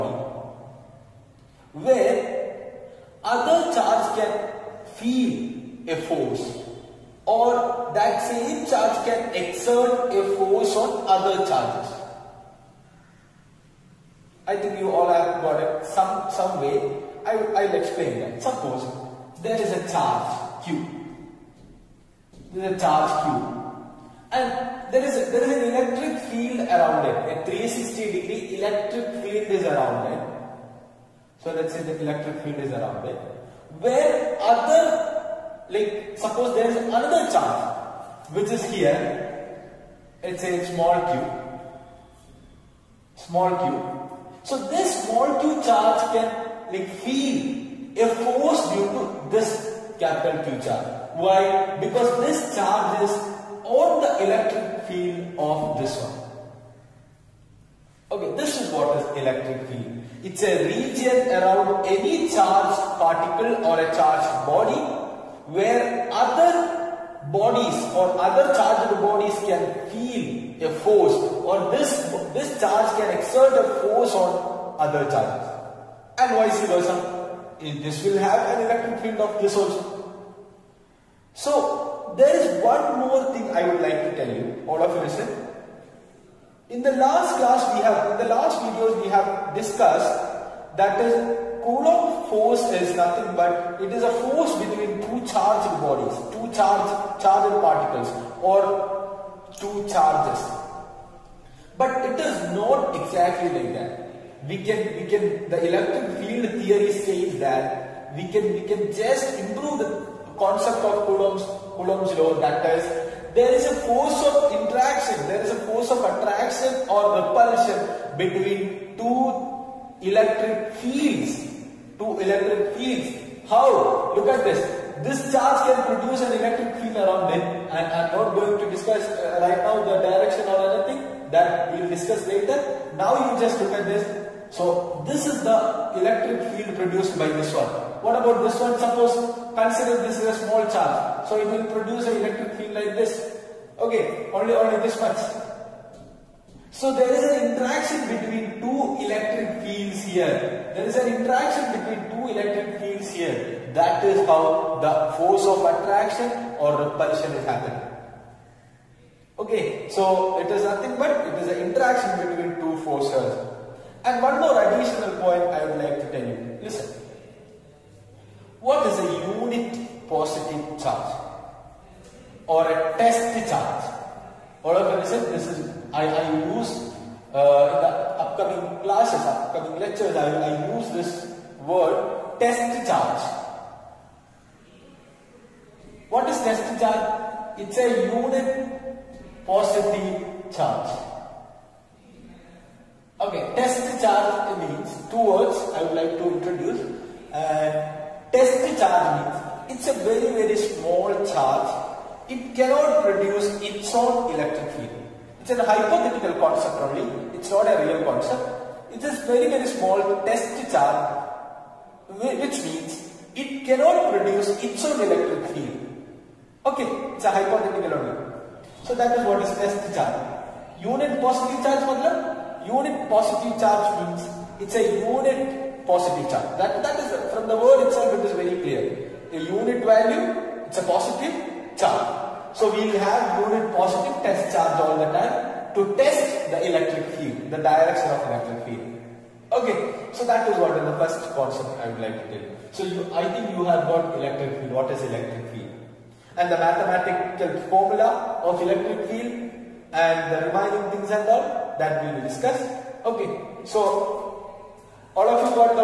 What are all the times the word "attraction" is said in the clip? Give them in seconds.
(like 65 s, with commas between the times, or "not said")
115 s, 155 s.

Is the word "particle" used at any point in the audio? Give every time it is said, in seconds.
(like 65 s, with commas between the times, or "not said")
62 s, 97 s.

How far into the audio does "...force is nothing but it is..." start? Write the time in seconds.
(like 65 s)
92 s.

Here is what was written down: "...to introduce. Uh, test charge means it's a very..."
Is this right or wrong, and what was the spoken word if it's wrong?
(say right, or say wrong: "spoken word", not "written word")
right.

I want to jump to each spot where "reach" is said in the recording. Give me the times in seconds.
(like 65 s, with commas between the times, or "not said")
not said.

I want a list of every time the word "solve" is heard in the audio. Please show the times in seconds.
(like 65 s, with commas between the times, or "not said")
not said.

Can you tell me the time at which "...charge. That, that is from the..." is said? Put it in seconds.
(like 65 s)
226 s.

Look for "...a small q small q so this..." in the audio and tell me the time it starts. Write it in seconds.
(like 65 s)
40 s.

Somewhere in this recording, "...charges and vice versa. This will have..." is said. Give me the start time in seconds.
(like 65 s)
75 s.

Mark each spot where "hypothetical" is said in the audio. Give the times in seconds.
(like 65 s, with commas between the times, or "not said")
205 s, 217 s.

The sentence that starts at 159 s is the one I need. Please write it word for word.
Okay, so it is nothing but it is an interaction between two forces.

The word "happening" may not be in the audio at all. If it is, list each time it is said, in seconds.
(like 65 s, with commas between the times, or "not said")
157 s.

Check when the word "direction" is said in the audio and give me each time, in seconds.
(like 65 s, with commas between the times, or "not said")
130 s, 237 s.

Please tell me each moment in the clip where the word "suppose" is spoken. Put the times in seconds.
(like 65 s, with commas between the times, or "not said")
18 s, 36 s, 138 s.